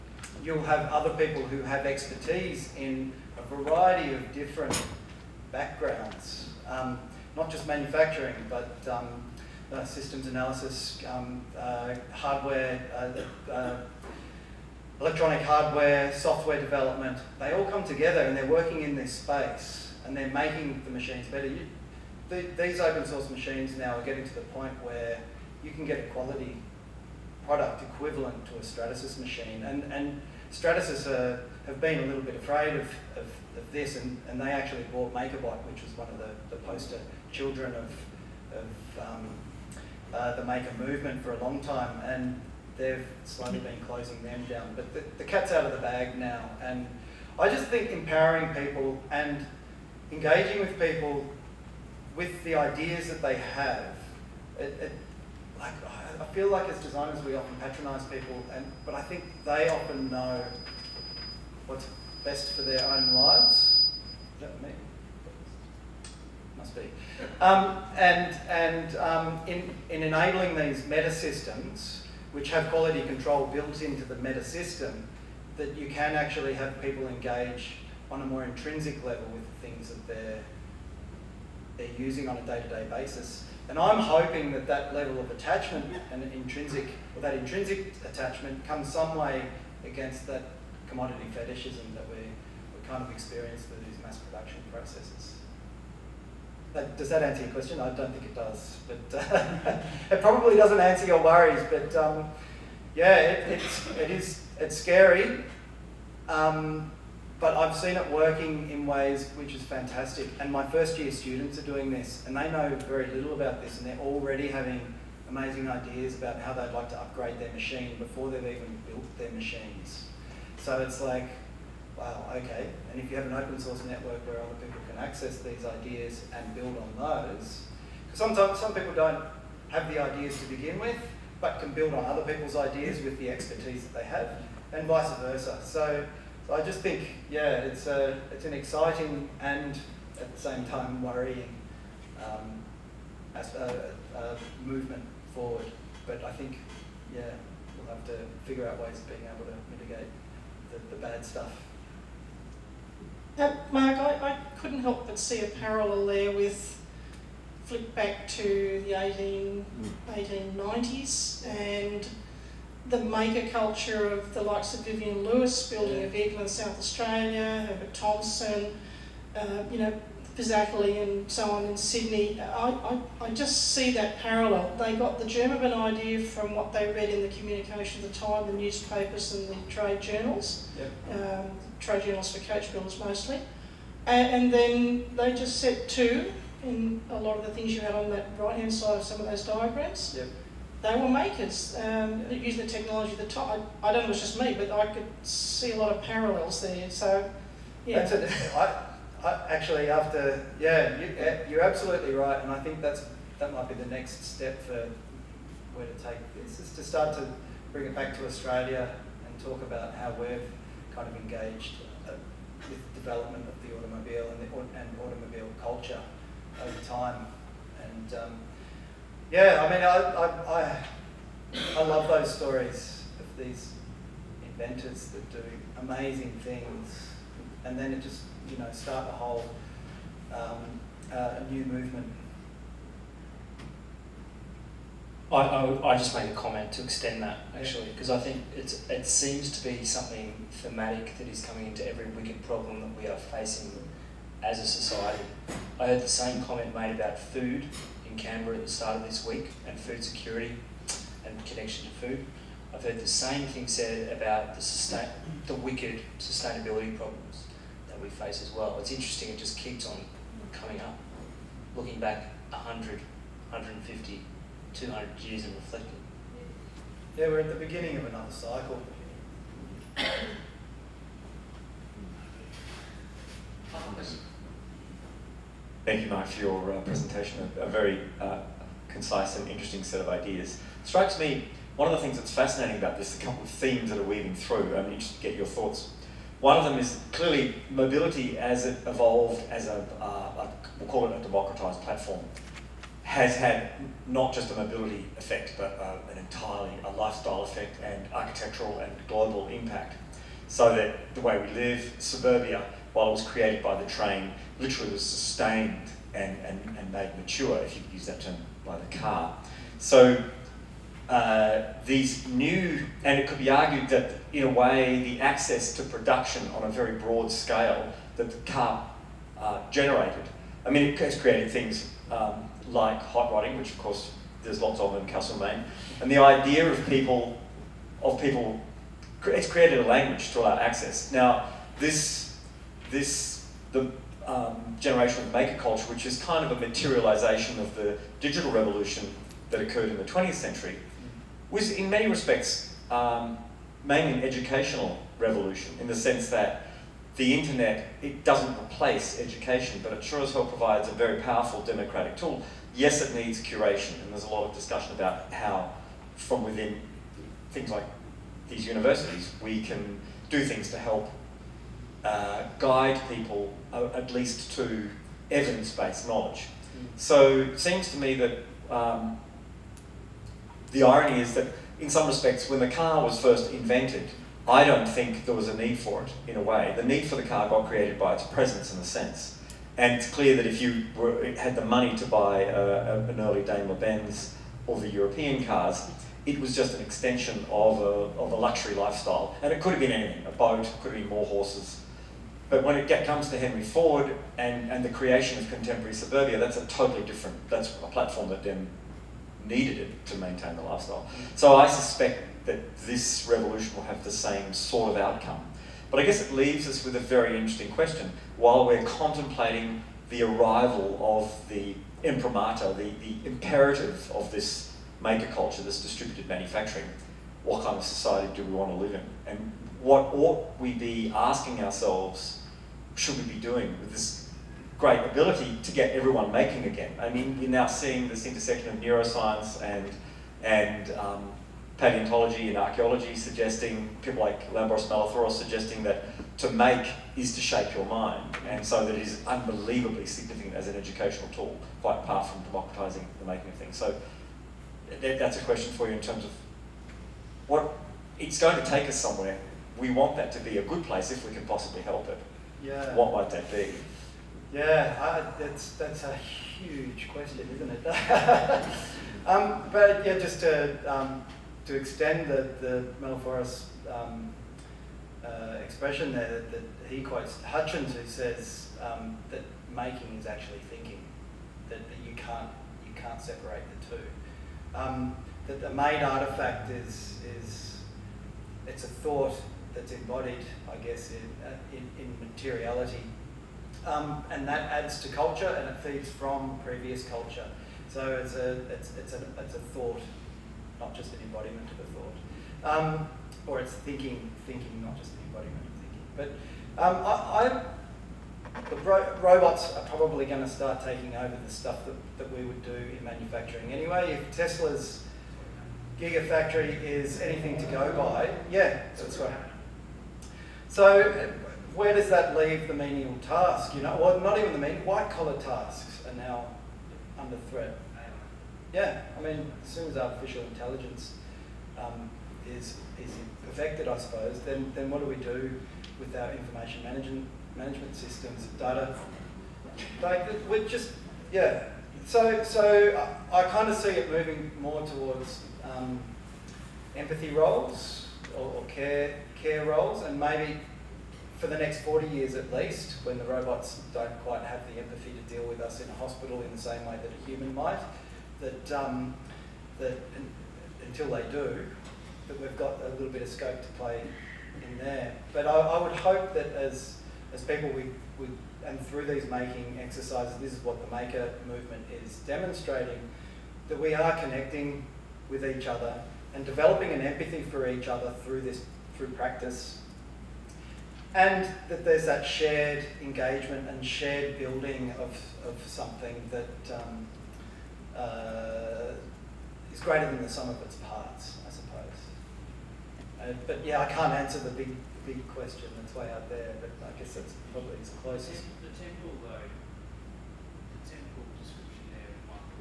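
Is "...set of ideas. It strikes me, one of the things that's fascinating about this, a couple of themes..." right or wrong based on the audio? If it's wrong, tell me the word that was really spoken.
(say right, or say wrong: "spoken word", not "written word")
right.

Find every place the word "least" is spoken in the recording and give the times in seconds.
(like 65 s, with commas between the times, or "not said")
364 s, 542 s.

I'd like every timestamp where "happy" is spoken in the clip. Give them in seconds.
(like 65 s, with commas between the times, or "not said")
not said.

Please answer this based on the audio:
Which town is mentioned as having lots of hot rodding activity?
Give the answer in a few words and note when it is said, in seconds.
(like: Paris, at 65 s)
Castlemaine, at 325 s.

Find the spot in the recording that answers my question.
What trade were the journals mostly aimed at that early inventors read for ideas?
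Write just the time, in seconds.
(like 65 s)
182 s.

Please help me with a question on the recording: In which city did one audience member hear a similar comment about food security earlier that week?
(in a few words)
Canberra.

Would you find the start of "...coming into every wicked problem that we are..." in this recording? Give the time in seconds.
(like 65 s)
241 s.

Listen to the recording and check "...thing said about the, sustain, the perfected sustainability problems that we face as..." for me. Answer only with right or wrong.
wrong.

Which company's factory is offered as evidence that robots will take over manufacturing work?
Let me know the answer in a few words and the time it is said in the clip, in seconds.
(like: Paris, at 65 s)
Tesla, at 504 s.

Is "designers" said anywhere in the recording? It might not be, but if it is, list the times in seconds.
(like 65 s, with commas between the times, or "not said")
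56 s.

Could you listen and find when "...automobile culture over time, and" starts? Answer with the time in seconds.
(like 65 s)
215 s.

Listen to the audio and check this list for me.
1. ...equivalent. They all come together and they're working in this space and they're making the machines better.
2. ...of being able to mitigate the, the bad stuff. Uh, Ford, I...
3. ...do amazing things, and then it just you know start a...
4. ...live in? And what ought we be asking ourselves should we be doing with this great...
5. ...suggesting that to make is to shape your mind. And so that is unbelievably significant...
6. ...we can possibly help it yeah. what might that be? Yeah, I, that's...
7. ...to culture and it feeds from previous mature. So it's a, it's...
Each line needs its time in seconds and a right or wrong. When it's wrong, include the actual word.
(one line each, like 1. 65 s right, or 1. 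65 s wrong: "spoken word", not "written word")
1. 16 s wrong: "development", not "equivalent"
2. 148 s wrong: "Mark", not "Ford"
3. 225 s right
4. 418 s right
5. 435 s right
6. 451 s right
7. 485 s wrong: "culture", not "mature".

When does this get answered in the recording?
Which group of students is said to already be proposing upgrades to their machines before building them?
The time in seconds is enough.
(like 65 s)
110 s.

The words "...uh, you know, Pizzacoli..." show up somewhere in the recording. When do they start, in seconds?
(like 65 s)
169 s.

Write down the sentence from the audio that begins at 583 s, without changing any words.
Uh, but yeah, I can't answer the big, big question that's way out there, but I guess that's probably The temple, though.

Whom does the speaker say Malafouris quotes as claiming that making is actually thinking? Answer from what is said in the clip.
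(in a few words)
Hutchins.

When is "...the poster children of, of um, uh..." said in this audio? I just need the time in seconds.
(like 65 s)
36 s.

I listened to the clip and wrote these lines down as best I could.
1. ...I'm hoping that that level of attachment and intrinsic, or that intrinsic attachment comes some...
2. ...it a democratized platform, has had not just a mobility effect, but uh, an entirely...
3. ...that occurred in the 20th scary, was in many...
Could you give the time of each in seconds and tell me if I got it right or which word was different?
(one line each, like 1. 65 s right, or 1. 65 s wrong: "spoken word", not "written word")
1. 83 s right
2. 291 s right
3. 339 s wrong: "century", not "scary".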